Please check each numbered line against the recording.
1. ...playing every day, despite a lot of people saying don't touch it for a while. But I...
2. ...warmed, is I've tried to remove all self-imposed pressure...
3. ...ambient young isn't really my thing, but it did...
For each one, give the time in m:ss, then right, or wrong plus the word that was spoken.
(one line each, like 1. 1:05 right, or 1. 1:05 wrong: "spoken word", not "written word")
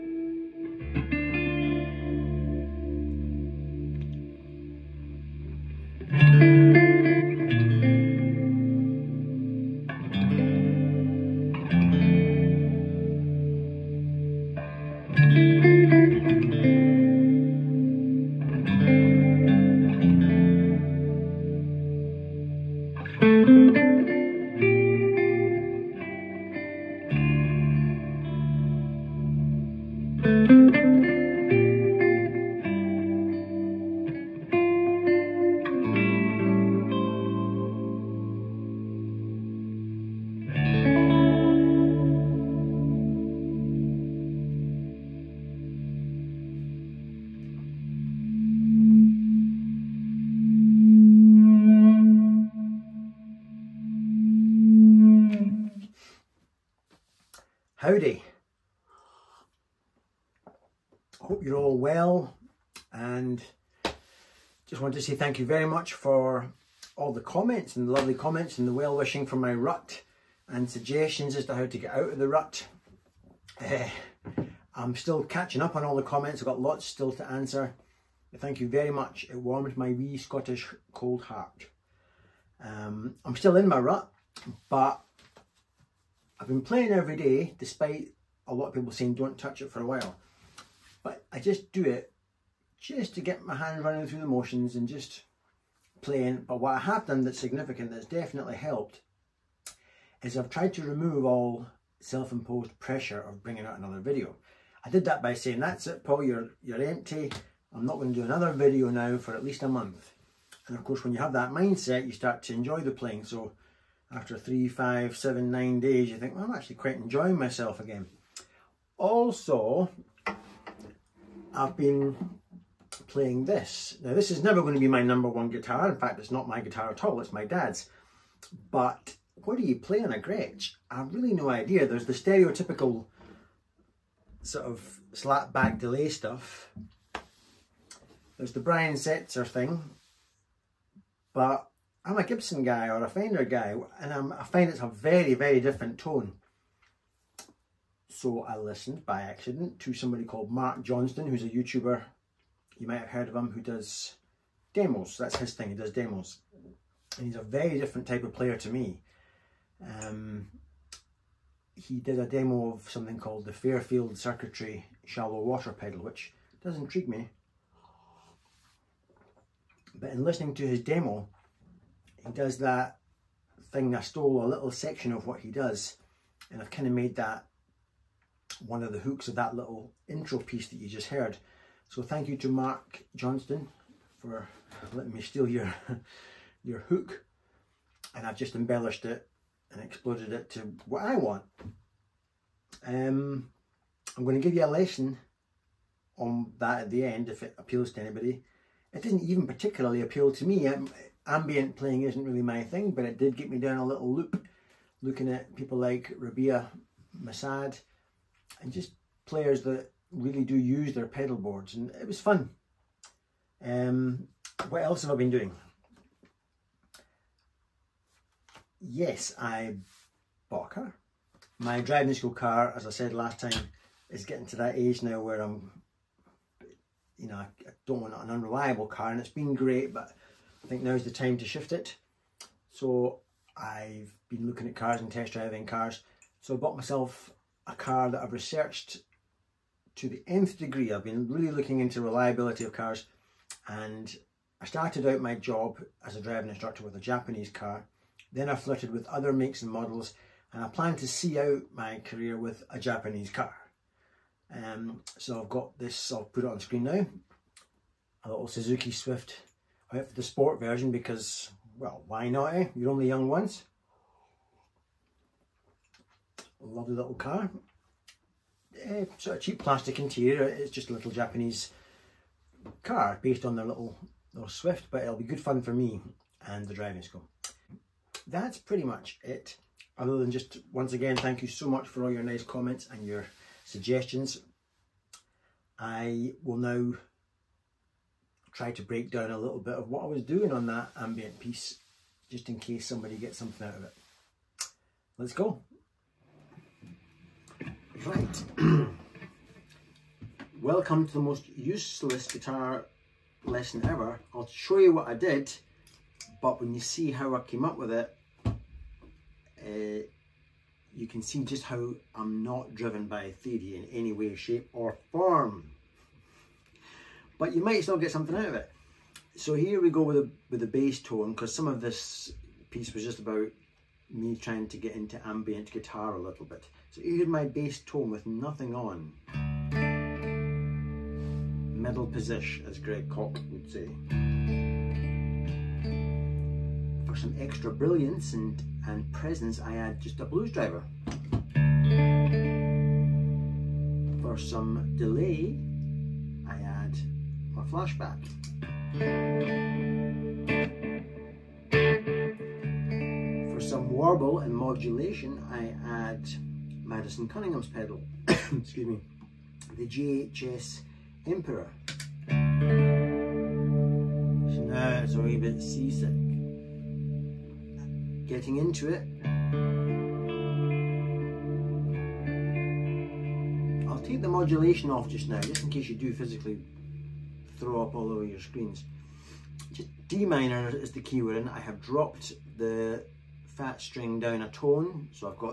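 1. 1:26 right
2. 1:38 wrong: "helped", not "warmed"
3. 3:21 wrong: "playing", not "young".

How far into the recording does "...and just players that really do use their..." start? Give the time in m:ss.
3:28.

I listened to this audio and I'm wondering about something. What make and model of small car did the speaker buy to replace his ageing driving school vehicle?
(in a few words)
Suzuki Swift.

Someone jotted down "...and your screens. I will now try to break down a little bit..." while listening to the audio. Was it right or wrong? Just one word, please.
wrong.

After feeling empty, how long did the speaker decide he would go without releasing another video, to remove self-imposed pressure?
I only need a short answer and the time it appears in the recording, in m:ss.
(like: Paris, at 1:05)
at least a month, at 1:49.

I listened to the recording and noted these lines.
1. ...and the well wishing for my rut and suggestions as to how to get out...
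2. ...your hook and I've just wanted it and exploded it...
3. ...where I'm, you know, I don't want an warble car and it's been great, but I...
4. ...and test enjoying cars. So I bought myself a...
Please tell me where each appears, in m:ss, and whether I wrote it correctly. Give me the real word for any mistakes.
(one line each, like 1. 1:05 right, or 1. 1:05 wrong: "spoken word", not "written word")
1. 1:08 right
2. 3:06 wrong: "embellished", not "wanted"
3. 3:45 wrong: "unreliable", not "warble"
4. 3:55 wrong: "driving", not "enjoying".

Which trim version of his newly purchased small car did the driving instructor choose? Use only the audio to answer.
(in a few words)
sport.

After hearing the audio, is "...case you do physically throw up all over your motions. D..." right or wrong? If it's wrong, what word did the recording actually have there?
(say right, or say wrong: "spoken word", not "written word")
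wrong: "screens", not "motions".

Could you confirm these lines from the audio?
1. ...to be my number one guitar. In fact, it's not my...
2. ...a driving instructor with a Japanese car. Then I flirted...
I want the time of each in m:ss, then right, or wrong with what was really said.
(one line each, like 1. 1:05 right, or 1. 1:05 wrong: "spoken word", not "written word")
1. 2:04 right
2. 4:06 right.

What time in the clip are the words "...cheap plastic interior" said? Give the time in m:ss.
4:29.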